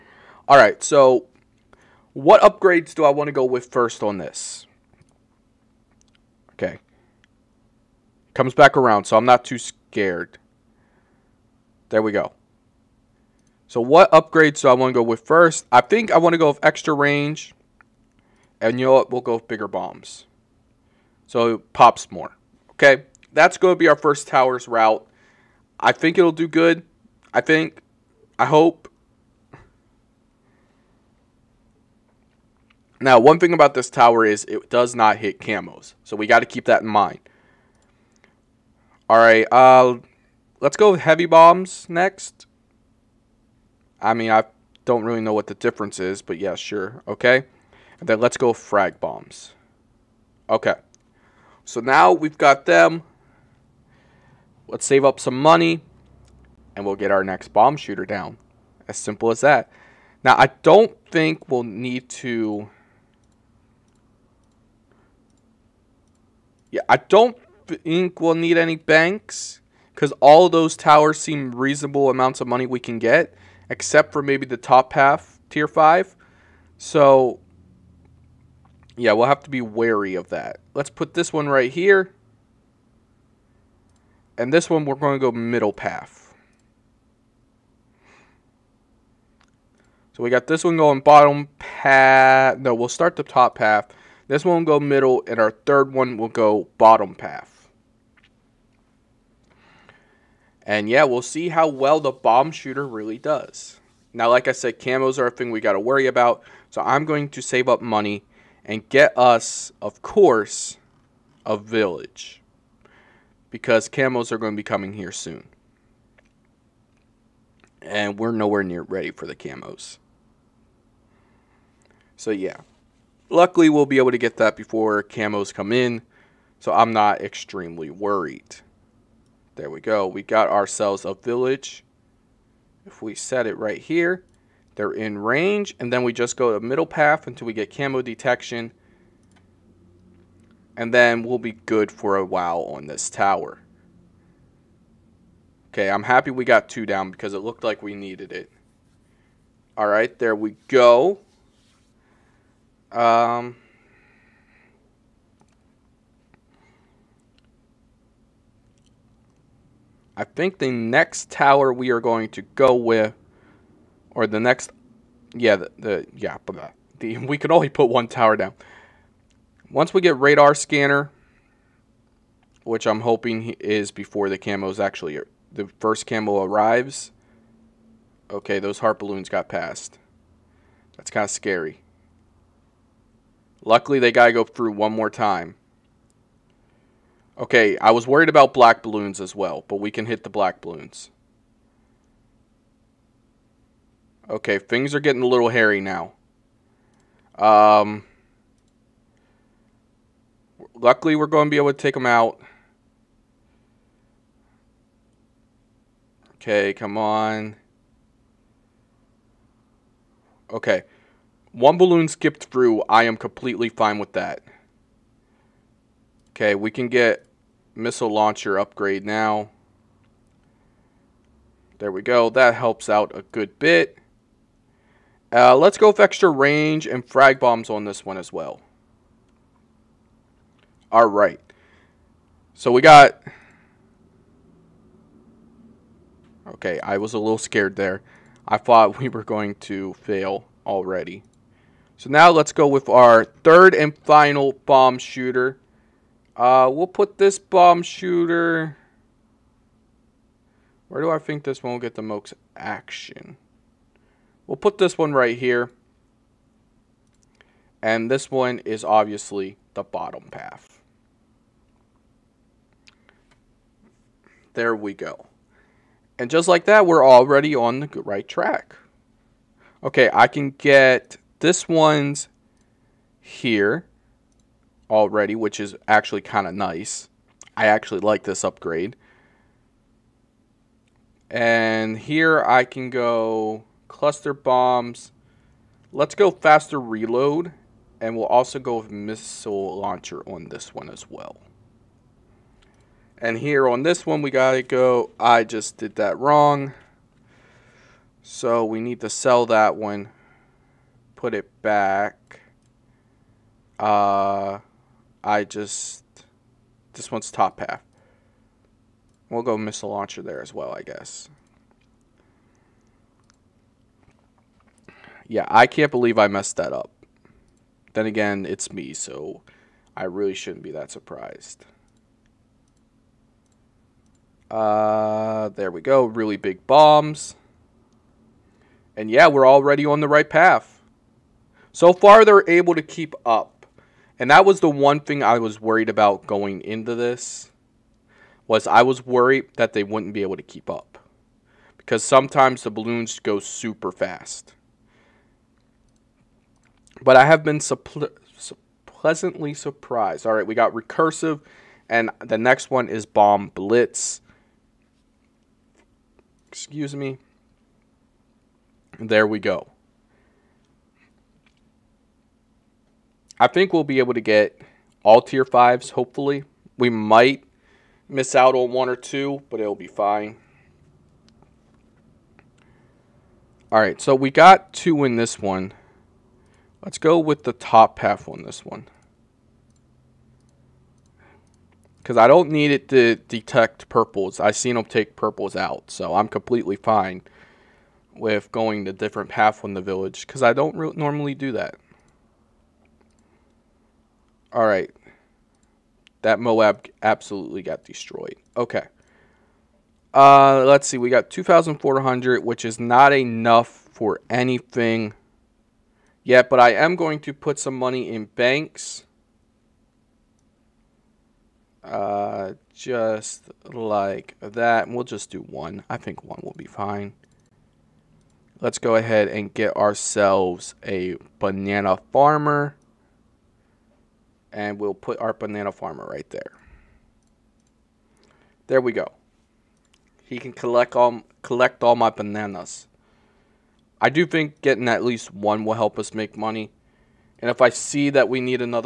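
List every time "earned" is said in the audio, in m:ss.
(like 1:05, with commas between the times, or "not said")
not said.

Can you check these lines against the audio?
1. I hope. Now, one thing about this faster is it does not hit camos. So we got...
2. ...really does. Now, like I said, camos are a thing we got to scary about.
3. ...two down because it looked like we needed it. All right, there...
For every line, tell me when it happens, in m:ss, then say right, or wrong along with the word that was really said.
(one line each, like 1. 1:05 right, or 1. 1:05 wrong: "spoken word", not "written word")
1. 0:28 wrong: "tower", not "faster"
2. 1:42 wrong: "worry", not "scary"
3. 2:26 right.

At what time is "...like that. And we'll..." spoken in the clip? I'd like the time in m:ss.
6:53.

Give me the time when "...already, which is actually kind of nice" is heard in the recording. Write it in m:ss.
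4:34.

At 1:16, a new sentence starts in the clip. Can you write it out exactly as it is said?
So, yeah, we'll have to be wary of that.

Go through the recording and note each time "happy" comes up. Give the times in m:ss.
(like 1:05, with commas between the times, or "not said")
2:26.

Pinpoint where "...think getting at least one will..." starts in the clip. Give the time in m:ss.
7:14.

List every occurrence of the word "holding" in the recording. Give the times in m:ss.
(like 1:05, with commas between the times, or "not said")
not said.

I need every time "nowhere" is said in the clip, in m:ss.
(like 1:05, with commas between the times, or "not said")
1:58.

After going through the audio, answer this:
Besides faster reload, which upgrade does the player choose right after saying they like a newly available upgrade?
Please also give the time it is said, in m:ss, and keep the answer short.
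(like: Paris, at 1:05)
Cluster bombs, at 4:43.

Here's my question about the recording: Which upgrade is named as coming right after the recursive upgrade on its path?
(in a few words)
Bomb blitz.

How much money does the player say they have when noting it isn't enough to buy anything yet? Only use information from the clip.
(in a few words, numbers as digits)
2,400.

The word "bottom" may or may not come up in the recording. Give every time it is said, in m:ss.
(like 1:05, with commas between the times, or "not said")
1:31, 1:36, 4:19.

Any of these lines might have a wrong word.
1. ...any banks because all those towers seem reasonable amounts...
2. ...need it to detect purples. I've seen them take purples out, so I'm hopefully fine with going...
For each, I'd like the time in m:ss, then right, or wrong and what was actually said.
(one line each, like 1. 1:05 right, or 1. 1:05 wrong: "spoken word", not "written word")
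1. 1:08 right
2. 6:22 wrong: "completely", not "hopefully".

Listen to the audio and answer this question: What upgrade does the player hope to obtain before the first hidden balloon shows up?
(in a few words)
Radar scanner.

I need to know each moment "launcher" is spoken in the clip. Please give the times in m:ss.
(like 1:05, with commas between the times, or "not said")
3:38, 4:49, 5:09.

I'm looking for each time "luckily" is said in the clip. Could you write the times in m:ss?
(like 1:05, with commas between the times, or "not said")
2:03, 3:03, 3:20.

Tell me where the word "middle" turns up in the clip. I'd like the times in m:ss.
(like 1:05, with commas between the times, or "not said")
1:25, 1:34, 2:16.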